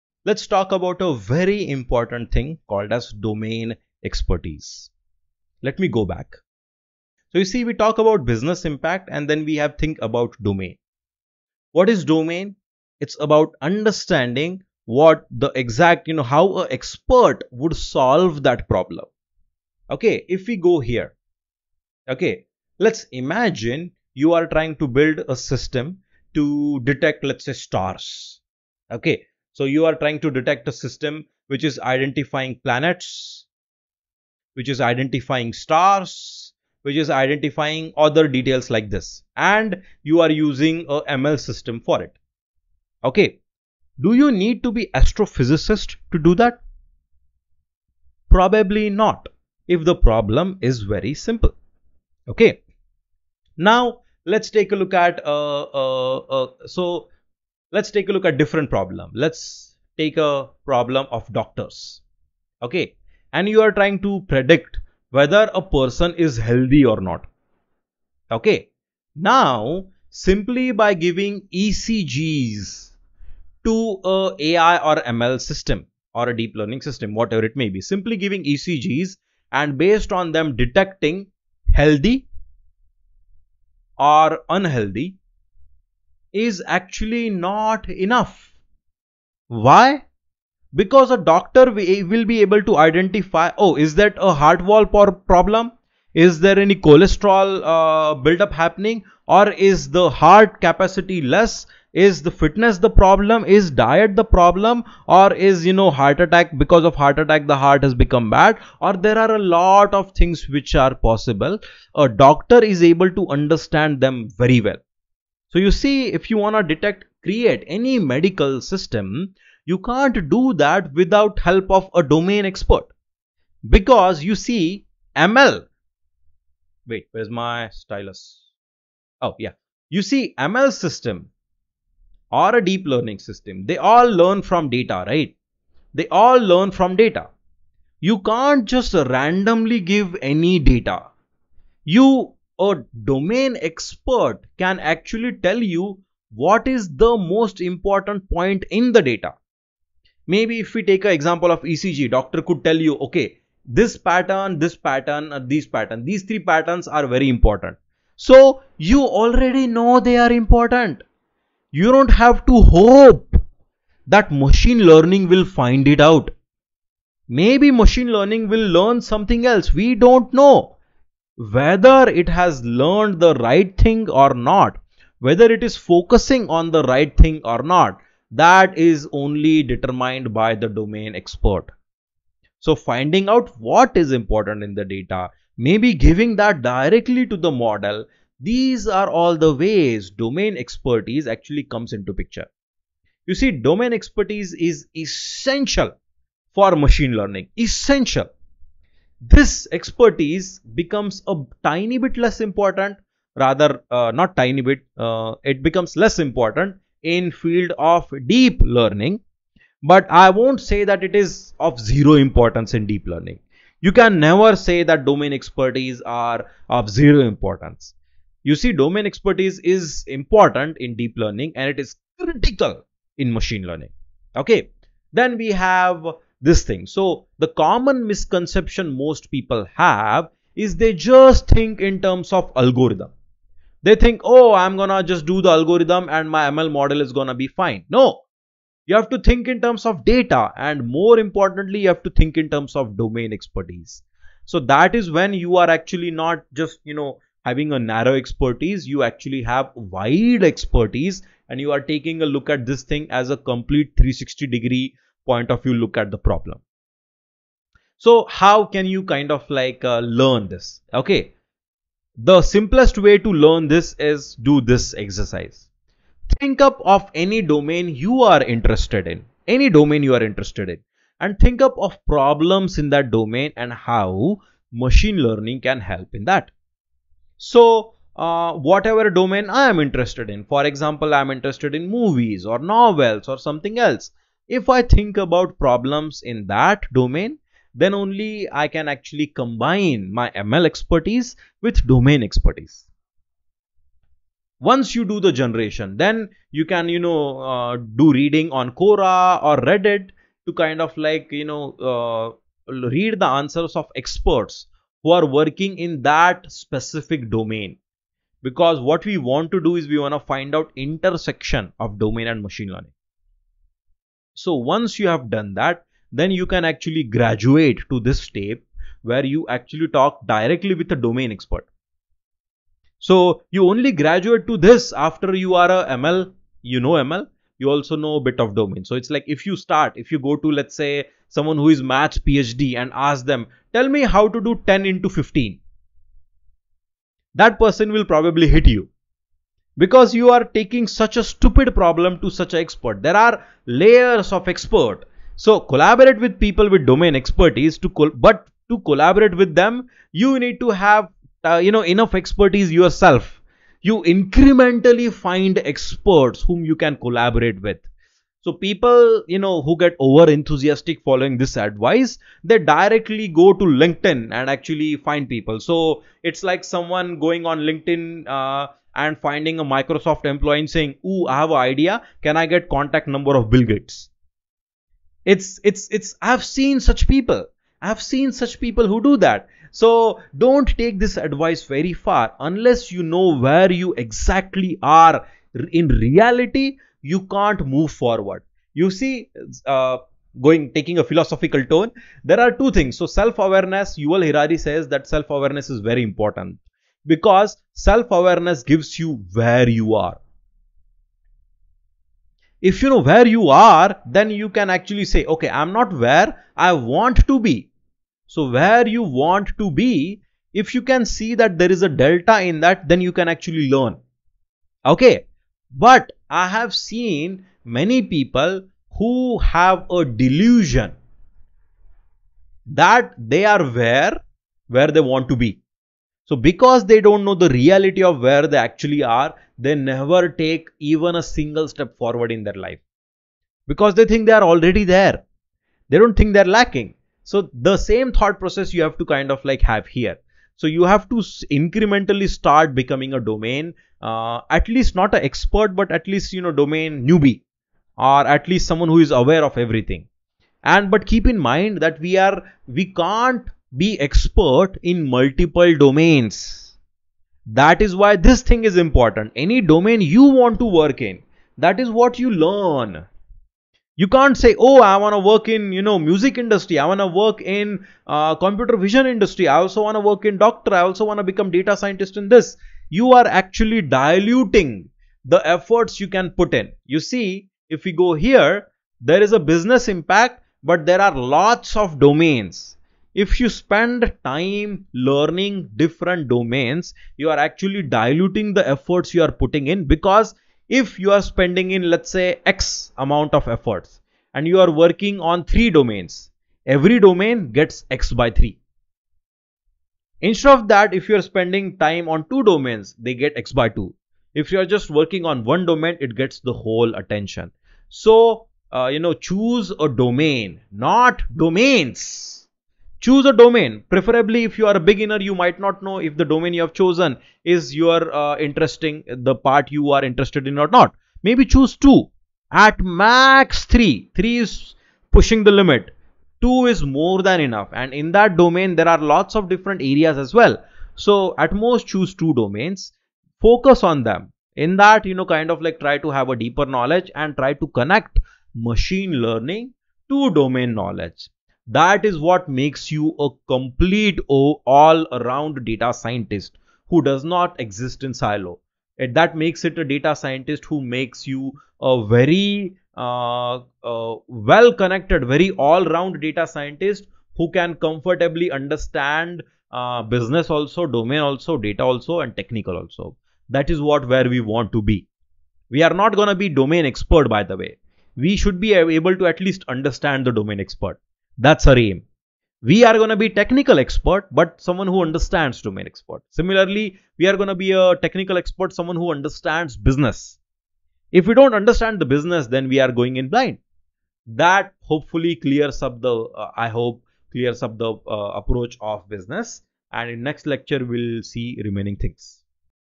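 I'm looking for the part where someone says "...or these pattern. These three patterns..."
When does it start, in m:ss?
2:35.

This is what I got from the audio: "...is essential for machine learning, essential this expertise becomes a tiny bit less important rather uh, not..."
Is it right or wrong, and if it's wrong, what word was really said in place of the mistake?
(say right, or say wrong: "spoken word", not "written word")
right.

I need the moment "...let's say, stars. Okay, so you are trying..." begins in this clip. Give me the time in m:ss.
0:27.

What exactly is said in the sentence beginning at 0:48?
Probably not if the problem is very simple.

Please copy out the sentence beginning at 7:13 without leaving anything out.
Because they think they are already there.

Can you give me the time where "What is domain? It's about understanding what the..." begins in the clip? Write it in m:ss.
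0:11.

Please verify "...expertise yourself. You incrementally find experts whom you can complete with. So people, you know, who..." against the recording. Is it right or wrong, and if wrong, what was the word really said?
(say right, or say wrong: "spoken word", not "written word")
wrong: "collaborate", not "complete".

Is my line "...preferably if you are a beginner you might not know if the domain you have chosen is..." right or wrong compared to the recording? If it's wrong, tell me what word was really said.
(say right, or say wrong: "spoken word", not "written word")
right.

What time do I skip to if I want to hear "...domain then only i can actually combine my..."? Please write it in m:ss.
4:46.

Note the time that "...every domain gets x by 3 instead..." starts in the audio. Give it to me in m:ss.
8:16.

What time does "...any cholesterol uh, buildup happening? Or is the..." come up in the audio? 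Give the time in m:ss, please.
1:36.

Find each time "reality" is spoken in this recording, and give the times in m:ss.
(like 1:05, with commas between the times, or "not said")
6:25, 7:07.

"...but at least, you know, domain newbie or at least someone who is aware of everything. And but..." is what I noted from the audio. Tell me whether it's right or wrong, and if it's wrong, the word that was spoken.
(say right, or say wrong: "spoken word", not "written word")
right.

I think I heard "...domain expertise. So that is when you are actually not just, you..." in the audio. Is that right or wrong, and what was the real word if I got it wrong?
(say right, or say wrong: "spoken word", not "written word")
right.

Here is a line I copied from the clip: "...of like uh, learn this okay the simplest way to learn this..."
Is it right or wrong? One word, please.
right.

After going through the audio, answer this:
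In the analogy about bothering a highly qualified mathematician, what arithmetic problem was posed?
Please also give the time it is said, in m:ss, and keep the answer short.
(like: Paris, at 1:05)
10 into 15, at 5:34.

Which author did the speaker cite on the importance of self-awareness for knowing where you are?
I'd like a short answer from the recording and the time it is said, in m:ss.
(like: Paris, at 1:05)
Yuval Harari, at 6:33.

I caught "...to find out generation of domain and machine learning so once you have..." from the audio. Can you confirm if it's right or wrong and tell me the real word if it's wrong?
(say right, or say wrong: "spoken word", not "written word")
wrong: "intersection", not "generation".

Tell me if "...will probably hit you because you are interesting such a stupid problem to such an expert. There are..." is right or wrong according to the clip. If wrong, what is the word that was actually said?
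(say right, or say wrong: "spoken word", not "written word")
wrong: "taking", not "interesting".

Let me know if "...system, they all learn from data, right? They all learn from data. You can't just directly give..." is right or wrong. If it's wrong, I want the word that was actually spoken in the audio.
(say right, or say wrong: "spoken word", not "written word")
wrong: "randomly", not "directly".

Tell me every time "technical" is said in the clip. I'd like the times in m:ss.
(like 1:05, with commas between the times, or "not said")
9:22, 9:33, 9:37.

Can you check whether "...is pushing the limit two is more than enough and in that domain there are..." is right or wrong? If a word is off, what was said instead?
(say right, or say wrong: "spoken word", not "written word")
right.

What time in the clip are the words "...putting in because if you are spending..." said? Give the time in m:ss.
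8:09.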